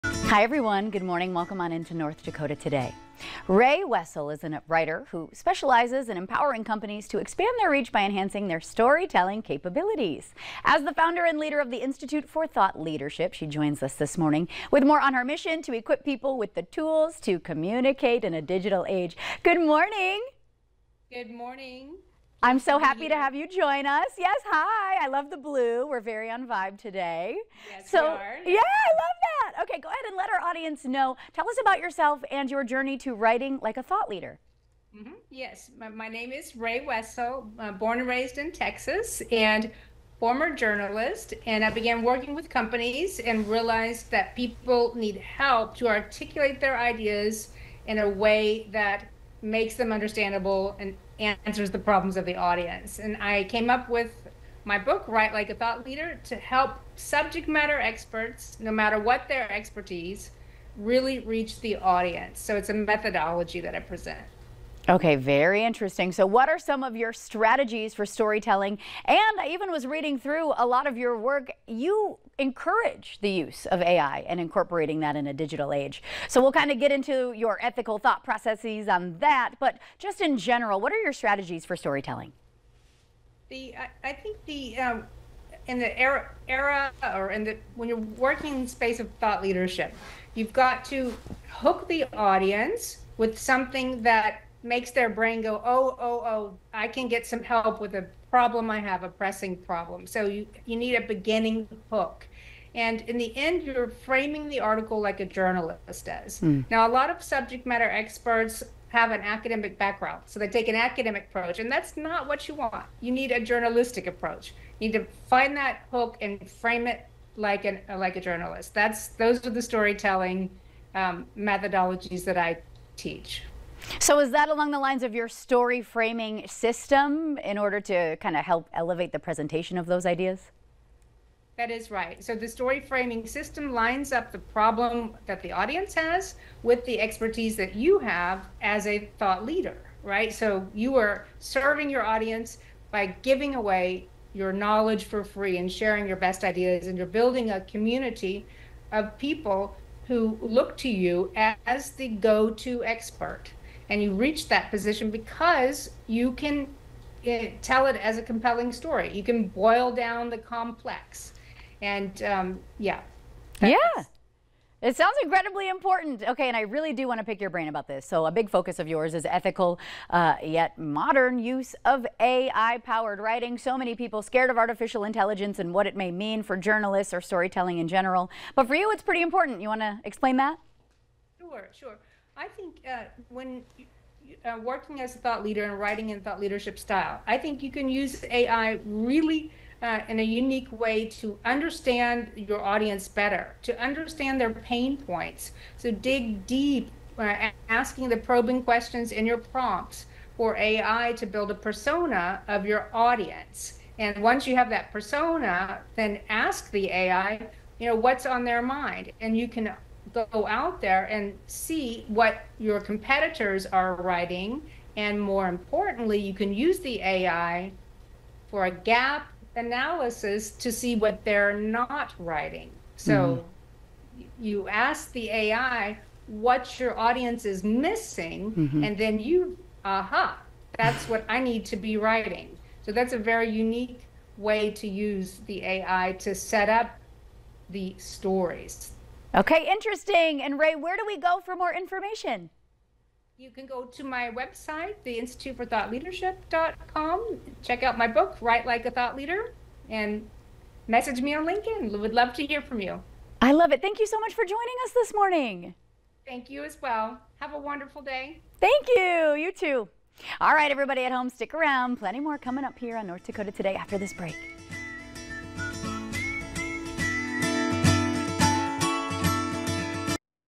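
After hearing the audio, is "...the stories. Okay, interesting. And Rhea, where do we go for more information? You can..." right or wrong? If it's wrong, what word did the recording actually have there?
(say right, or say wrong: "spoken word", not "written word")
right.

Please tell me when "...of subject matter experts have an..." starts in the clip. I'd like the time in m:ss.
1:47.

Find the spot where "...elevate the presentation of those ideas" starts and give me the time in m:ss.
2:08.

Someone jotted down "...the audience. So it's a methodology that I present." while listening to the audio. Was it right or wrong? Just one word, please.
right.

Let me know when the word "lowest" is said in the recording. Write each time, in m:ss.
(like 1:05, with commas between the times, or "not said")
not said.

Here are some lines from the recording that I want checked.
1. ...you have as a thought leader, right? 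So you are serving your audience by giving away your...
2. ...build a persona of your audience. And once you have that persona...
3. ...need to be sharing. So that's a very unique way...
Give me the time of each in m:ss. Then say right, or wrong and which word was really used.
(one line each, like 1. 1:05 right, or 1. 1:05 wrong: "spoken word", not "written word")
1. 2:17 right
2. 3:21 right
3. 3:51 wrong: "writing", not "sharing".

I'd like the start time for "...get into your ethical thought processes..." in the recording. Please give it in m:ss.
1:16.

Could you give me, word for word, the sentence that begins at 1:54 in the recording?
You need to find that hook and frame it like an like a journalist.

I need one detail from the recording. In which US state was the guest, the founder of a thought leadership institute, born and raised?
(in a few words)
Texas.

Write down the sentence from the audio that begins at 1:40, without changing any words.
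So you, you need a beginning hook.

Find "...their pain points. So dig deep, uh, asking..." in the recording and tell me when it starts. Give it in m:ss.
3:14.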